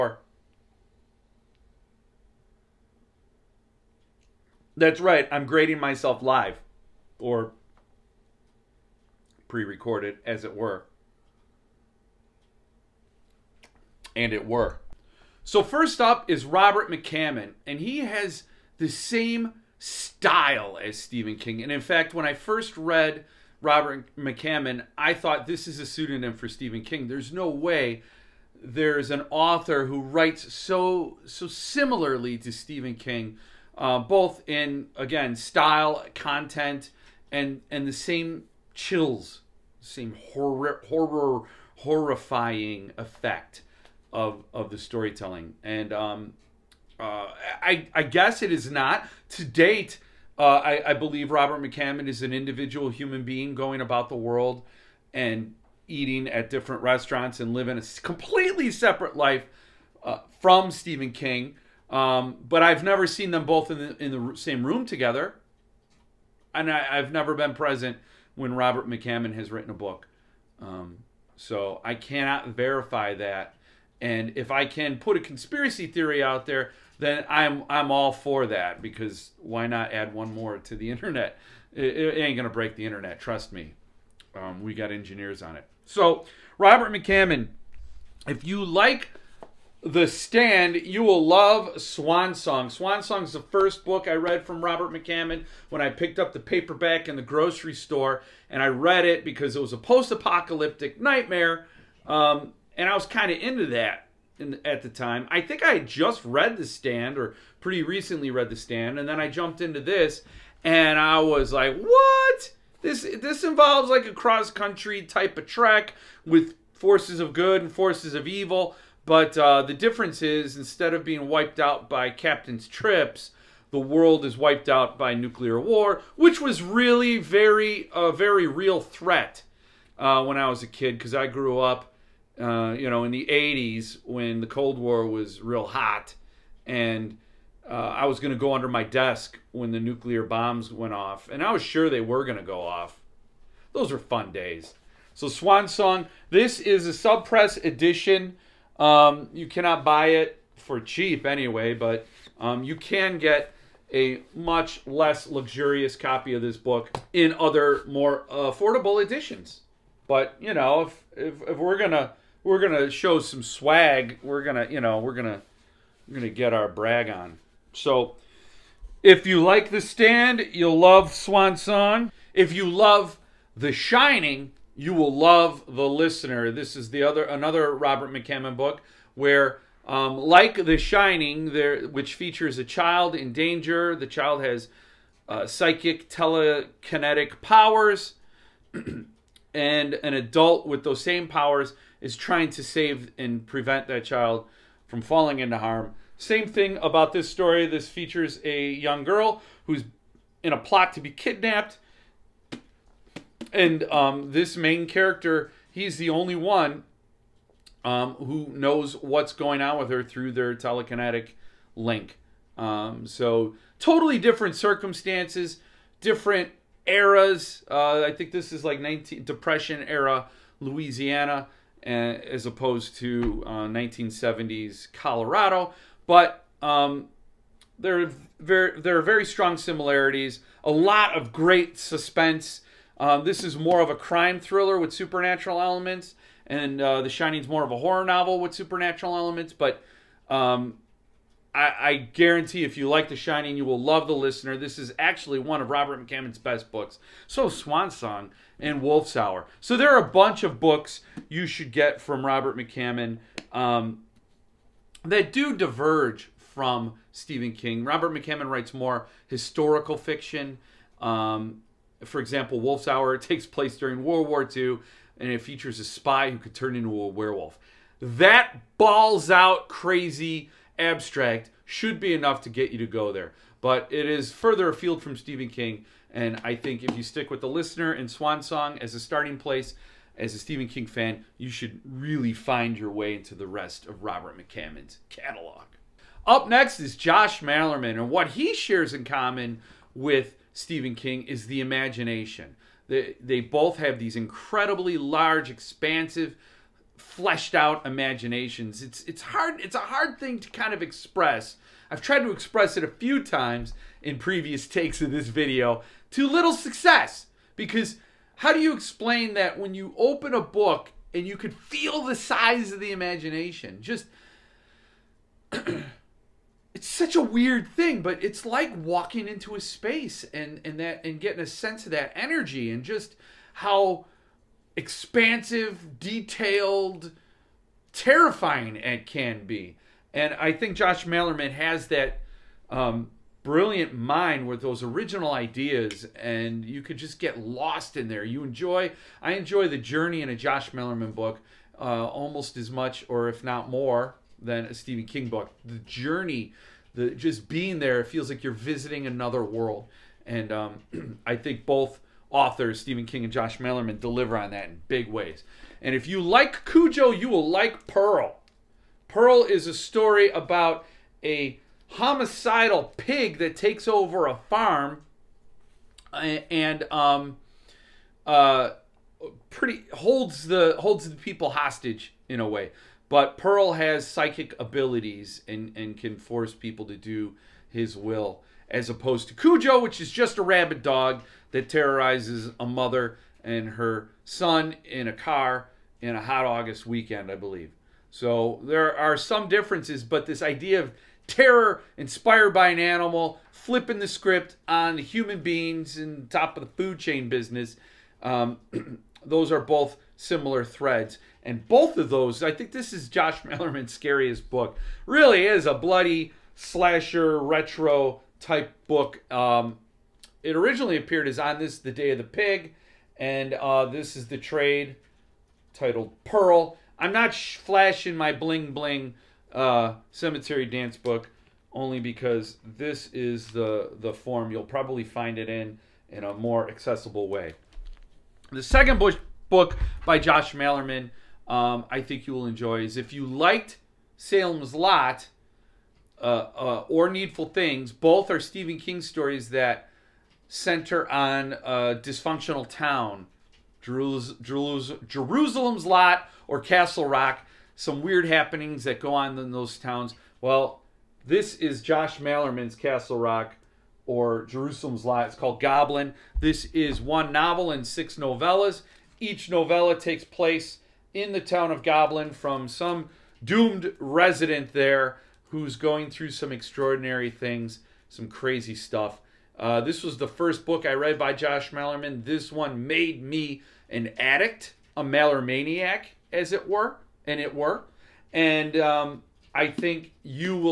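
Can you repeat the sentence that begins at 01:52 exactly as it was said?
This this involves like a cross country type of trek with forces of good and forces of evil.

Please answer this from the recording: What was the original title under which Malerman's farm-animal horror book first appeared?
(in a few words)
On This, the Day of the Pig.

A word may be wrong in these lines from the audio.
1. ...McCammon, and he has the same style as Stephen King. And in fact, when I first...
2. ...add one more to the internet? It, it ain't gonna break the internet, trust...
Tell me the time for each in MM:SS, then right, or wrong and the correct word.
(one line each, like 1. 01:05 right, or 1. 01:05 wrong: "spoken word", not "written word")
1. 00:16 right
2. 01:19 right.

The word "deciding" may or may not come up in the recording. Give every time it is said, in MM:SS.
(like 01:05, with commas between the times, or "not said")
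not said.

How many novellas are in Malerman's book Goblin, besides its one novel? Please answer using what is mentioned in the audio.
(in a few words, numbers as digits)
6.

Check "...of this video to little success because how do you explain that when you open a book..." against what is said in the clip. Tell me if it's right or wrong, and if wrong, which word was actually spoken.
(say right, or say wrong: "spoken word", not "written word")
right.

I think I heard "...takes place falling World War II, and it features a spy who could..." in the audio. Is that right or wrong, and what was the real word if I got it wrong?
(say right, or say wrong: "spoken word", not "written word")
wrong: "during", not "falling".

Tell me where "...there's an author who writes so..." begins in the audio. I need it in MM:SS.
00:28.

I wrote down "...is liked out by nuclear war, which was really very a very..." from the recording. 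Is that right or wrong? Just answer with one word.
wrong.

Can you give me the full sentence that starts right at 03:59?
But um, I, I guarantee if you like The Shining, you will love The Listener.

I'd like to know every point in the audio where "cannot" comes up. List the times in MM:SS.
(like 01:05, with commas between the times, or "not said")
01:11, 02:29.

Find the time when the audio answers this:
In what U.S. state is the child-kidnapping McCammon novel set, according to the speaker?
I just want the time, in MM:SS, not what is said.
03:40.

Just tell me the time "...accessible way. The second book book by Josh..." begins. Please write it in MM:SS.
07:06.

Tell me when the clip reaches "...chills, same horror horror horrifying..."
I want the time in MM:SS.
00:38.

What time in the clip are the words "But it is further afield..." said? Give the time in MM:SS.
04:33.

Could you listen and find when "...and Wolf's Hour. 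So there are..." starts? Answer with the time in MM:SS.
04:08.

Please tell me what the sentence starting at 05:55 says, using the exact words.
And if you like Cujo, you will like Pearl.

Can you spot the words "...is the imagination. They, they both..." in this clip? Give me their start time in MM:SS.
04:51.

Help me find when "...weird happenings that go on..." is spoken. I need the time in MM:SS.
07:28.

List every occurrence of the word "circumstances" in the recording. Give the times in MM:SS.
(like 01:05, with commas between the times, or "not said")
03:34.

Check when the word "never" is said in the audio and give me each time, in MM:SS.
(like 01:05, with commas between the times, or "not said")
01:02, 01:07.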